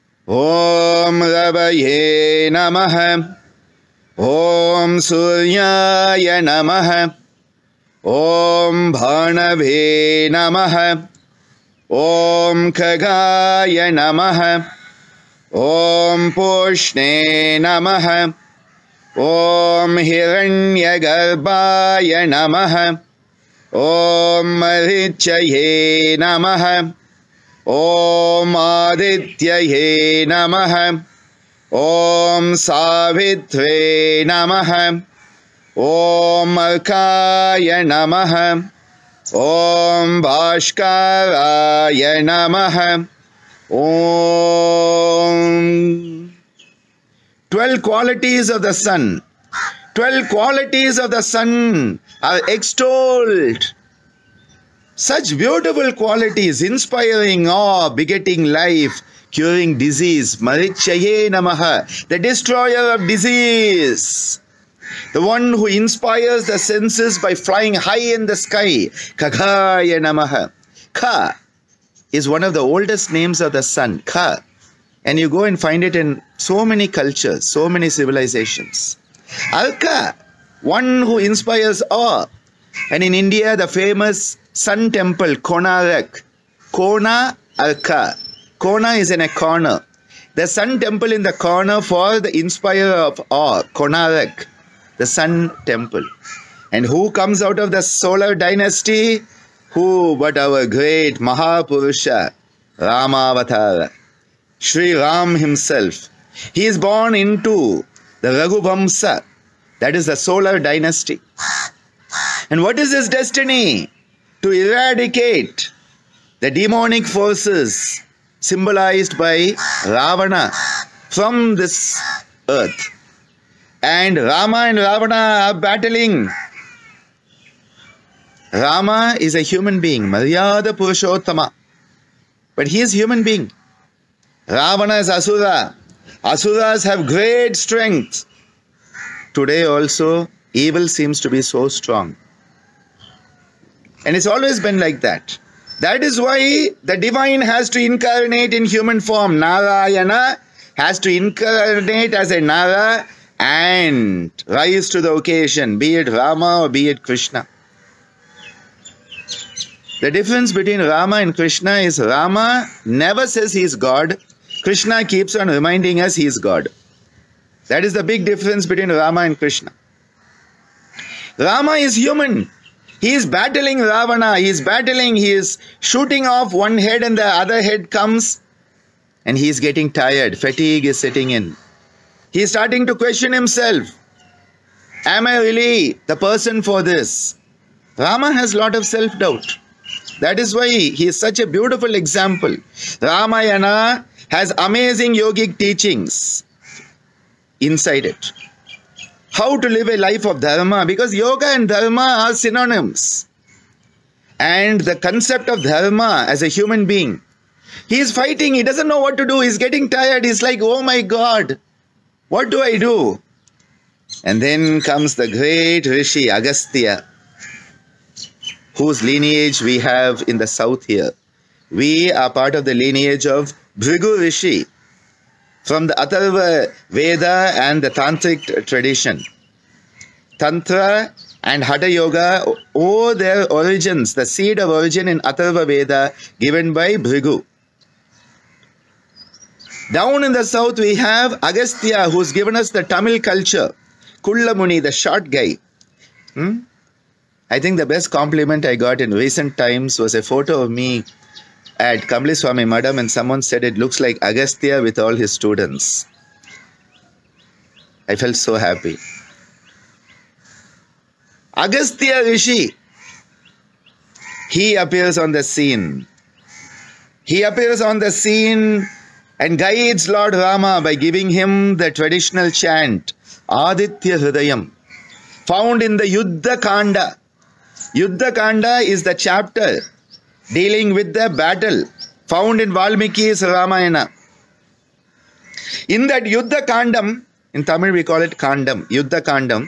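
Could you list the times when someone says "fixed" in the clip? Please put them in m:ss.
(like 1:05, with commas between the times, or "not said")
not said.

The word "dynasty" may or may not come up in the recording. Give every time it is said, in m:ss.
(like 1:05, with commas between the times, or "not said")
1:38, 1:50.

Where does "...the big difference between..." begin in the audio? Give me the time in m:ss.
2:47.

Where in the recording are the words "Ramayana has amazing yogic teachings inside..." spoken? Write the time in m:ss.
3:13.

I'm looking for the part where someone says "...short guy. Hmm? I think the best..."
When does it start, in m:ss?
4:04.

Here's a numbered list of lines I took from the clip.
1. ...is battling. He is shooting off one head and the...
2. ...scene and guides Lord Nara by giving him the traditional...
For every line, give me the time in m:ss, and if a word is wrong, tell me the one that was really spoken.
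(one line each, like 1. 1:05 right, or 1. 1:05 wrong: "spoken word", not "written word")
1. 2:54 right
2. 4:28 wrong: "Rama", not "Nara".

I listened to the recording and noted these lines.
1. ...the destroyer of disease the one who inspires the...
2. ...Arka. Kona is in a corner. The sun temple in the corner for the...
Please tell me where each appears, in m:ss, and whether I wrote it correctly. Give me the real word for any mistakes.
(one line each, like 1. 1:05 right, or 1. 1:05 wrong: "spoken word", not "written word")
1. 1:02 right
2. 1:27 right.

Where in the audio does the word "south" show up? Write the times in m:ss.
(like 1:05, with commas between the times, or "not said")
3:40, 4:00.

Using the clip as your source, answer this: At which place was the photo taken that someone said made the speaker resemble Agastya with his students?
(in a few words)
Kambliswamy Madam.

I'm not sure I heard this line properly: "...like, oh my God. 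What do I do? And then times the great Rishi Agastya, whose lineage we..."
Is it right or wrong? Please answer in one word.
wrong.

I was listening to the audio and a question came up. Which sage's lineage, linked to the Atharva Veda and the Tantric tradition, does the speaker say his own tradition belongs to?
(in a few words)
Bhrigu Rishi.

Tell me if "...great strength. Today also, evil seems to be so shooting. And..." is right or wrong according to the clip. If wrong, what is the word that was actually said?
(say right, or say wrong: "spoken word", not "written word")
wrong: "strong", not "shooting".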